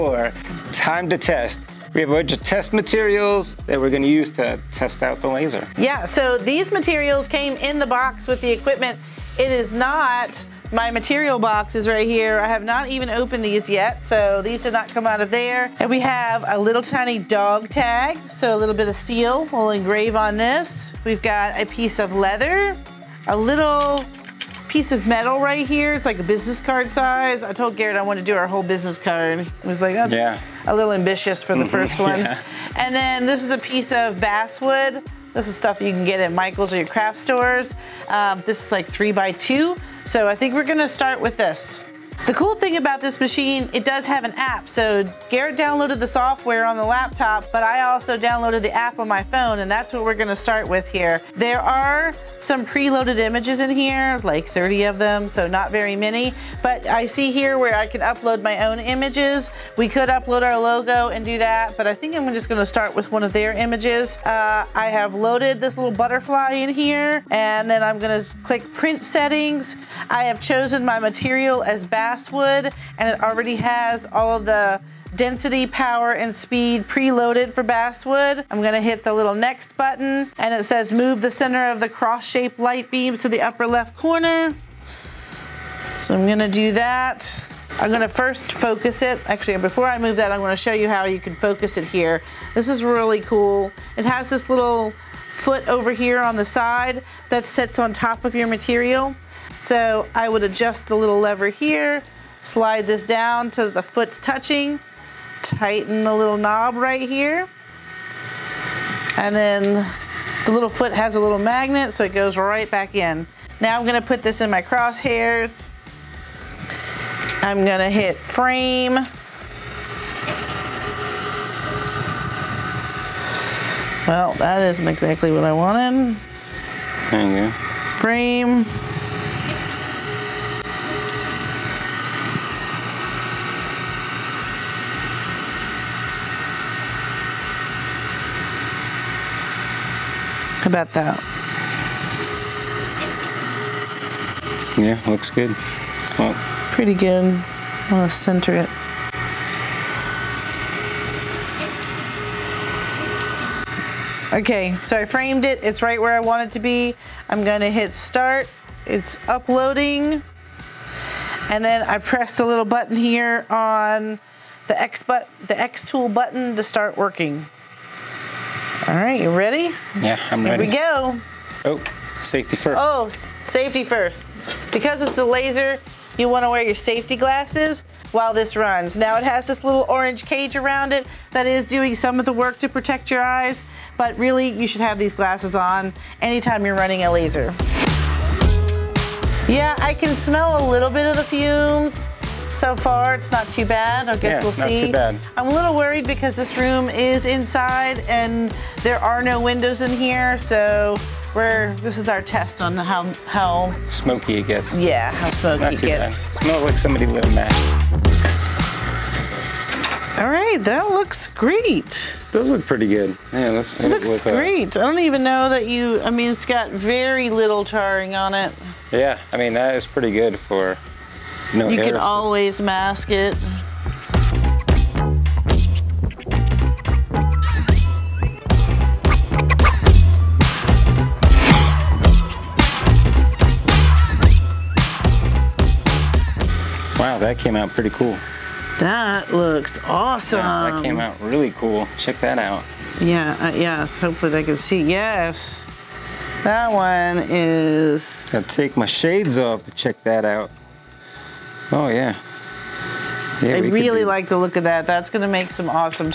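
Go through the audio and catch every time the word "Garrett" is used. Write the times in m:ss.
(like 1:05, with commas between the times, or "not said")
0:27, 0:45.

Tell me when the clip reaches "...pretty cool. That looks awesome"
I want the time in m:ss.
3:57.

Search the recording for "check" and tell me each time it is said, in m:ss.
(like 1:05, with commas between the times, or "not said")
4:01, 4:09.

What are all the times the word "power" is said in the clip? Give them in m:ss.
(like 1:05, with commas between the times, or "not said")
1:15.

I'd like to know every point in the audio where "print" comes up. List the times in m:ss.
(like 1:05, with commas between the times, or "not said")
1:08.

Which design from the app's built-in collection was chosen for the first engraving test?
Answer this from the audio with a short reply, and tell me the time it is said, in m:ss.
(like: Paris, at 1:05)
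Butterfly, at 1:05.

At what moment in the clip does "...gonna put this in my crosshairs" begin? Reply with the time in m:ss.
1:53.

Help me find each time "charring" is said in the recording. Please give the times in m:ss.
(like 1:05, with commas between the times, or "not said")
3:37.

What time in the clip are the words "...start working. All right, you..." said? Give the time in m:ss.
2:46.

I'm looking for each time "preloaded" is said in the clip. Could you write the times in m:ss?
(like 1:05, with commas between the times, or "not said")
0:52, 1:16.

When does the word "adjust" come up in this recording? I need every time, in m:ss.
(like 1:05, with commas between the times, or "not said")
1:40.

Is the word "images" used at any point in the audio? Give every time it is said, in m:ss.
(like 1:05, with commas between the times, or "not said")
0:53, 0:58, 1:03.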